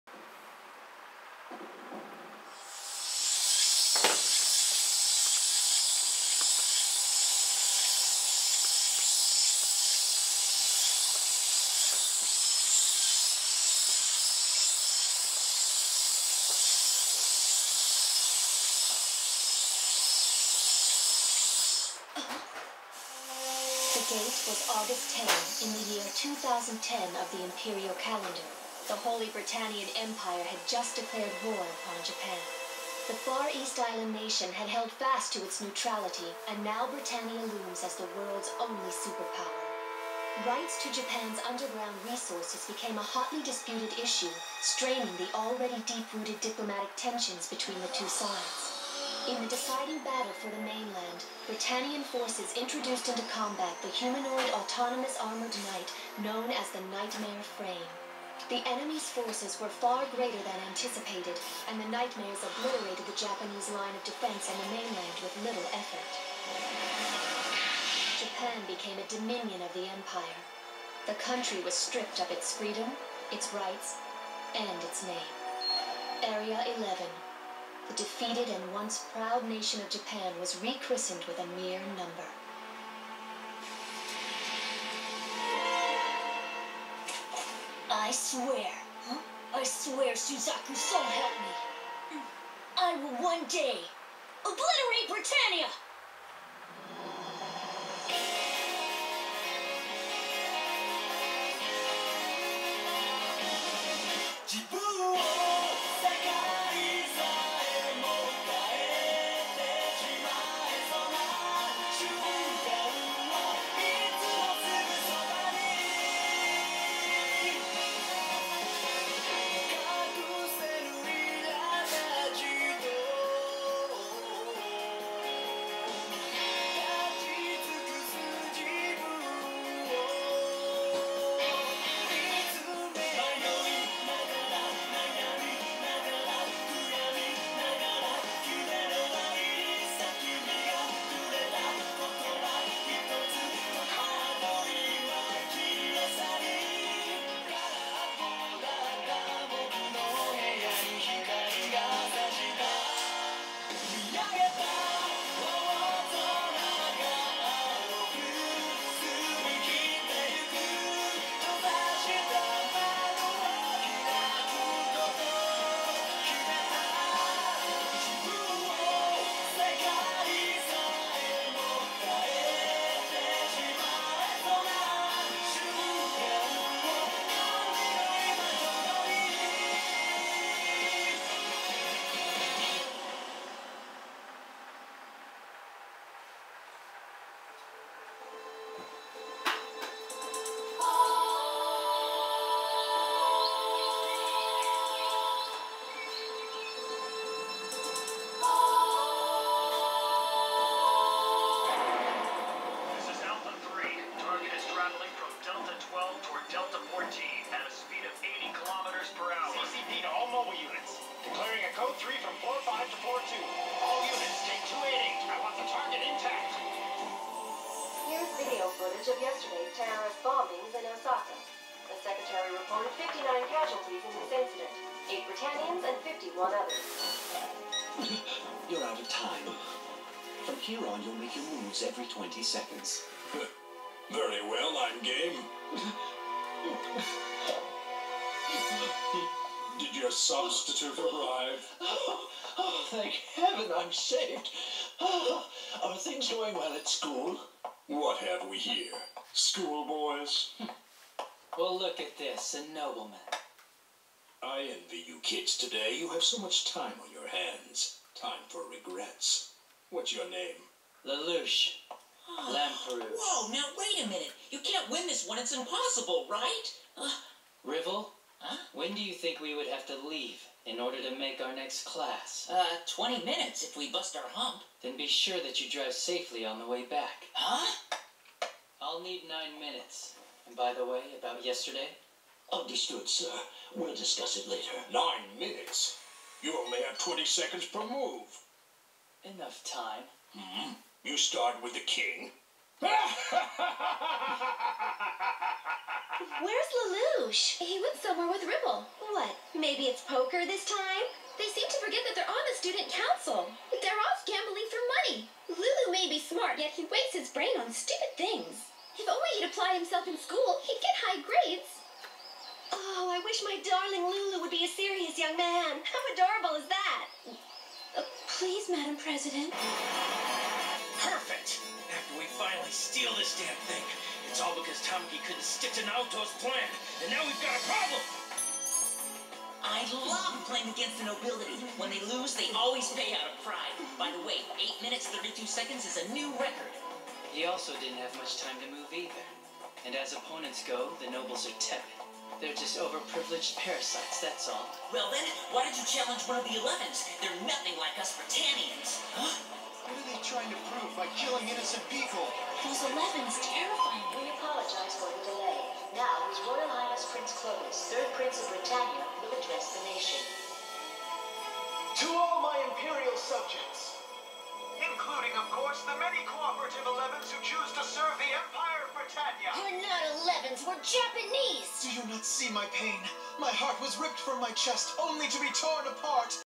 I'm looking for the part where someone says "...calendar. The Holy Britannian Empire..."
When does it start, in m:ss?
0:28.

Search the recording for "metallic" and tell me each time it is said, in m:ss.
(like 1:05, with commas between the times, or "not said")
not said.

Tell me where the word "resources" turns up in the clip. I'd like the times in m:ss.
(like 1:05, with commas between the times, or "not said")
0:42.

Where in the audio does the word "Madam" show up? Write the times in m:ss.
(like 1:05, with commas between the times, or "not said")
5:18.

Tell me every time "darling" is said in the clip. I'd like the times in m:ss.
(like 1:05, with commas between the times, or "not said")
5:13.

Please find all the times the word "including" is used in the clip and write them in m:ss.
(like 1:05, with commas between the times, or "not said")
6:04.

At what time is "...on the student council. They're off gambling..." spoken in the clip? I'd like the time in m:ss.
5:02.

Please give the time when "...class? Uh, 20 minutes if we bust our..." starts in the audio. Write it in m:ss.
4:31.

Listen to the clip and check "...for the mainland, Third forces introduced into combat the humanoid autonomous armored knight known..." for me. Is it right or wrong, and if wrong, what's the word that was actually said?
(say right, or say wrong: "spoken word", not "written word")
wrong: "Britannian", not "Third".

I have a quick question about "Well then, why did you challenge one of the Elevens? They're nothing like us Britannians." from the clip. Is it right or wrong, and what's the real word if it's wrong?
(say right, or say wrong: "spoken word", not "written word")
right.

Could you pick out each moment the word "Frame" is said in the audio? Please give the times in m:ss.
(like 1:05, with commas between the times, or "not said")
0:57.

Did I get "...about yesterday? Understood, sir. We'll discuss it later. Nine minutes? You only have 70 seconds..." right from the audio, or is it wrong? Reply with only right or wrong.
wrong.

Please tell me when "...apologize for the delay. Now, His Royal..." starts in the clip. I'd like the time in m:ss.
5:54.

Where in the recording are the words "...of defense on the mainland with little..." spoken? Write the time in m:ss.
1:03.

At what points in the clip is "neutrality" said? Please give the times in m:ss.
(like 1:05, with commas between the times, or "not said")
0:35.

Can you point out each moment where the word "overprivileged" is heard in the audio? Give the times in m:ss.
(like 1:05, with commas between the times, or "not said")
5:42.